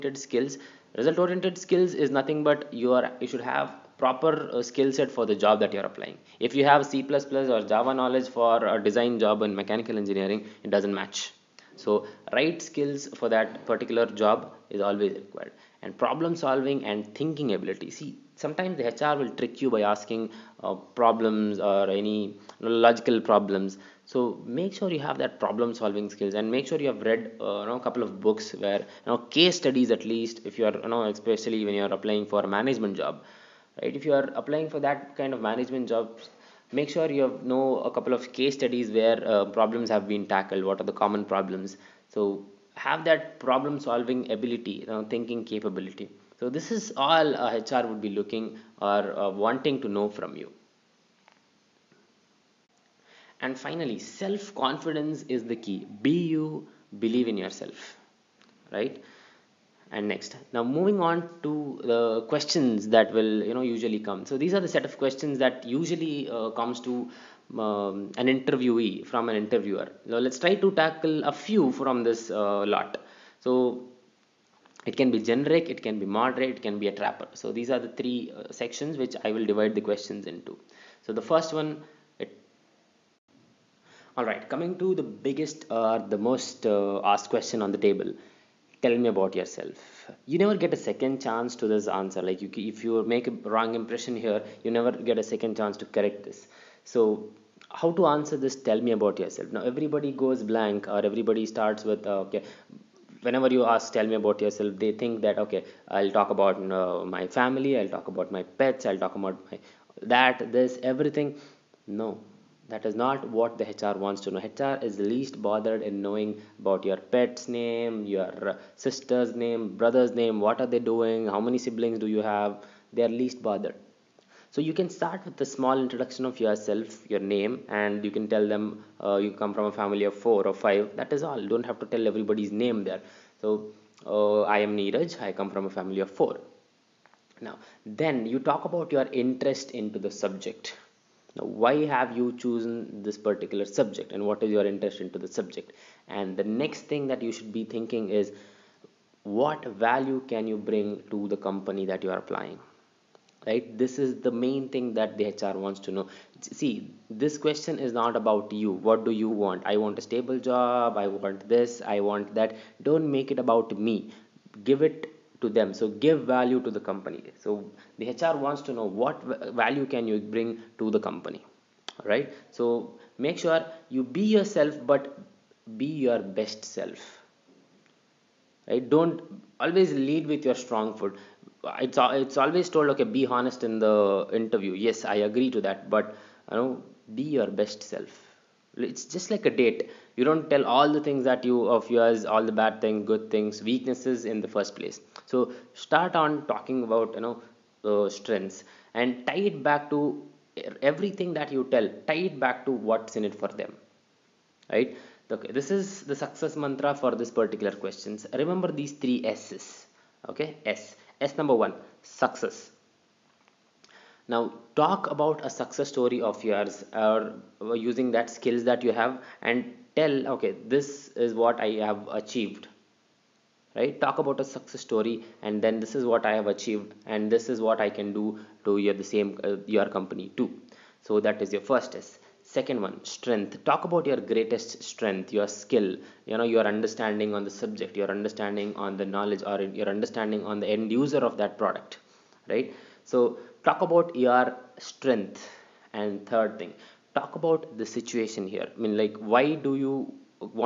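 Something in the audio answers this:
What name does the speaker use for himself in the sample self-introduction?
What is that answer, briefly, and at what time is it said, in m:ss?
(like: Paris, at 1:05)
Neeraj, at 2:14.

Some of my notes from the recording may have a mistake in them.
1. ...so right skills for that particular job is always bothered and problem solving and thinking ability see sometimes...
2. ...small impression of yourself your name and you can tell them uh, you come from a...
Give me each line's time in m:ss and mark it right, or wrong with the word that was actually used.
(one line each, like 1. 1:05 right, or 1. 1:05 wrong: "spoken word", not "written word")
1. 0:11 wrong: "required", not "bothered"
2. 2:05 wrong: "introduction", not "impression".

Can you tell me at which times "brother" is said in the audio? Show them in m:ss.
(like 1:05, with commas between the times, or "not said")
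1:59.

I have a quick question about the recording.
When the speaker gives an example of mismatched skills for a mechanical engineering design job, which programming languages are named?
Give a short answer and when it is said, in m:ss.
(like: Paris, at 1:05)
C++ or Java, at 0:06.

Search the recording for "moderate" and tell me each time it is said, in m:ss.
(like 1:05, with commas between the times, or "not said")
1:16.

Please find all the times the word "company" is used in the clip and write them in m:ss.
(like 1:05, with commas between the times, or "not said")
2:31, 2:46, 2:51, 3:49.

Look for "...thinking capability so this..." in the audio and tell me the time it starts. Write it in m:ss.
0:45.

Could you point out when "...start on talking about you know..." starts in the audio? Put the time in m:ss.
3:15.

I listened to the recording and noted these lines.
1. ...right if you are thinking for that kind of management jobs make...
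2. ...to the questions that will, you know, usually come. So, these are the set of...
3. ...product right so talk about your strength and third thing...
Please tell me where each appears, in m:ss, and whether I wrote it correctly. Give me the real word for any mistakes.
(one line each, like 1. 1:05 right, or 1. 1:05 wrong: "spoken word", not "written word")
1. 0:33 wrong: "applying", not "thinking"
2. 1:01 right
3. 4:01 right.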